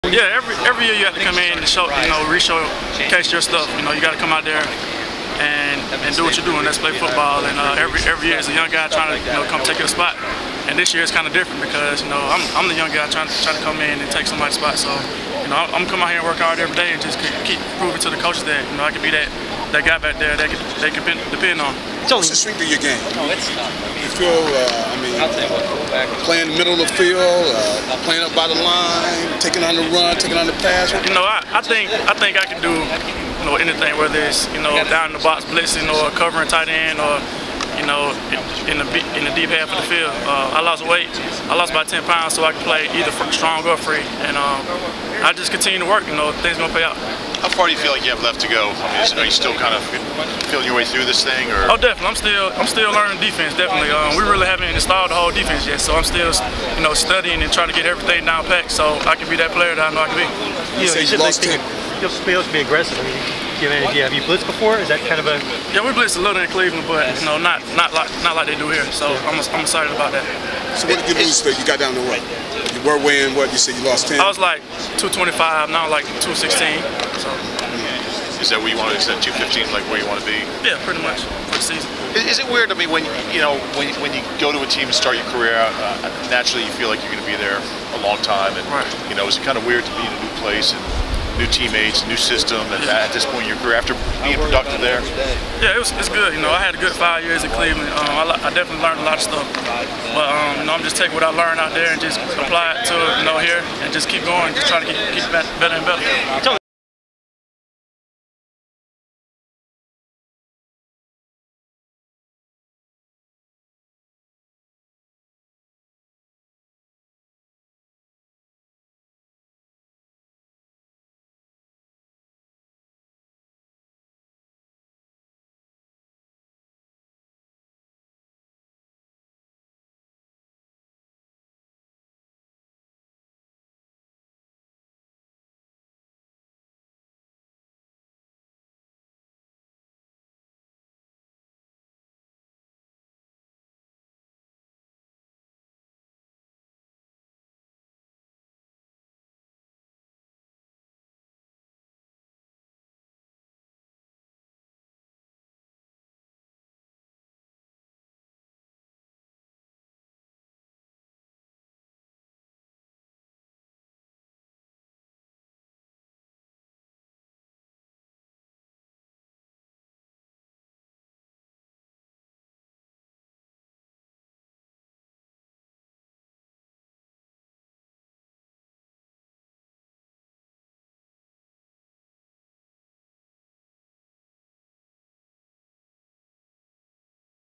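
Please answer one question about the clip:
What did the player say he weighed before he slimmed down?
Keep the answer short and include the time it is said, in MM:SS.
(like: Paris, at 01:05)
225, at 01:14.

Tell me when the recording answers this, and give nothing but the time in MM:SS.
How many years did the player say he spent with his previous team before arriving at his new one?
01:36.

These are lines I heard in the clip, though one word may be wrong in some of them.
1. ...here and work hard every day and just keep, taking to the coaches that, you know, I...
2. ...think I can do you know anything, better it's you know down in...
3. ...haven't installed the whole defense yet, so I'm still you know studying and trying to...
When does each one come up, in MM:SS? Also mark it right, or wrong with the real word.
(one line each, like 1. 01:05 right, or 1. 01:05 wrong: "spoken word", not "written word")
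1. 00:16 wrong: "proving", not "taking"
2. 00:32 wrong: "whether", not "better"
3. 00:54 right.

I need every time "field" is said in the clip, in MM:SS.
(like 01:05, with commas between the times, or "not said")
00:26, 00:39.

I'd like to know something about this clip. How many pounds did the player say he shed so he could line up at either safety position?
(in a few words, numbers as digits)
10.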